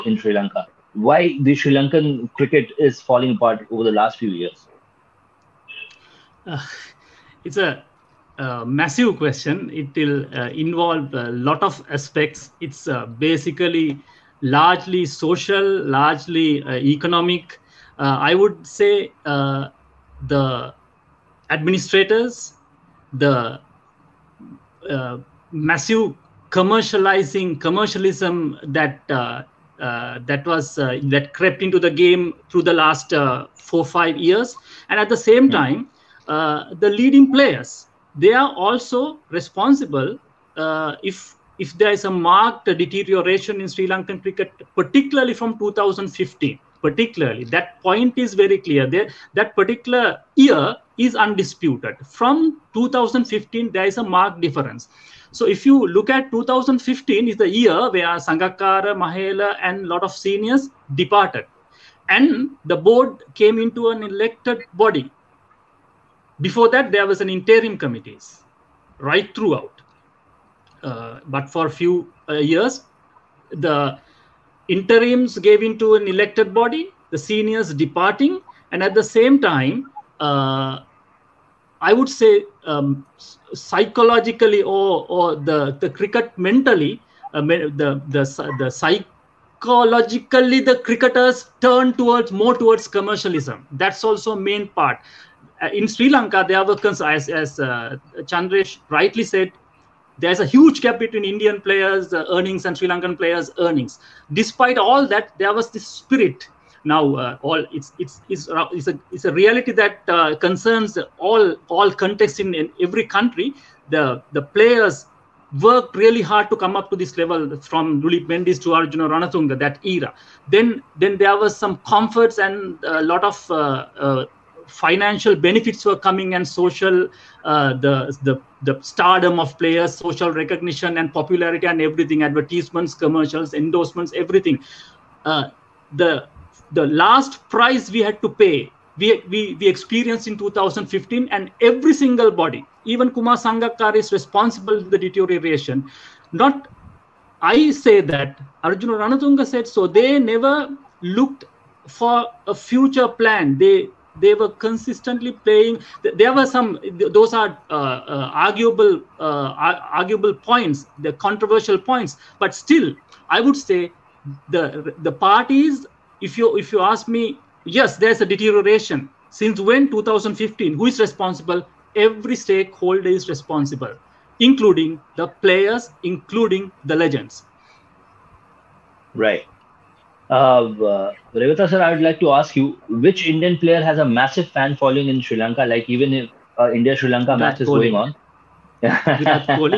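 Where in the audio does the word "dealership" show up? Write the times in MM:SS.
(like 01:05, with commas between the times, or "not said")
not said.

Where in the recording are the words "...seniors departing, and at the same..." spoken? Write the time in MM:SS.
01:17.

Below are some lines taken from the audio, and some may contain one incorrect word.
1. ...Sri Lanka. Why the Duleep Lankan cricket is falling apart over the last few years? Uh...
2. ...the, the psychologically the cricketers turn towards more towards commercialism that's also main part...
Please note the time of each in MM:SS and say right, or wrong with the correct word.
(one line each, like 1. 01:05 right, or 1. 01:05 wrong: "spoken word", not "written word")
1. 00:00 wrong: "Sri", not "Duleep"
2. 01:28 right.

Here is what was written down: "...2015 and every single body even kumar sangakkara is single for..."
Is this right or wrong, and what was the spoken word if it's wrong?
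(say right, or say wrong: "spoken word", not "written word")
wrong: "responsible", not "single".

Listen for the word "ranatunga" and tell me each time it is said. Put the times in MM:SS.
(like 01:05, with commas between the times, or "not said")
01:59, 02:29.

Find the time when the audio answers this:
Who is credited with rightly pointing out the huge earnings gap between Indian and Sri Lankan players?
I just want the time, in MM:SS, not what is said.
01:38.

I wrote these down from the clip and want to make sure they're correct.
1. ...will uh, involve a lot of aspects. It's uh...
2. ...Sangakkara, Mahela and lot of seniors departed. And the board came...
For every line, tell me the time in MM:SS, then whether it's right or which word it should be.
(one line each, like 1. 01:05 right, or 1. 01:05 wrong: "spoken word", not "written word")
1. 00:09 right
2. 00:58 right.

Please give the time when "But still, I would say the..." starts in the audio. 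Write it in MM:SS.
02:42.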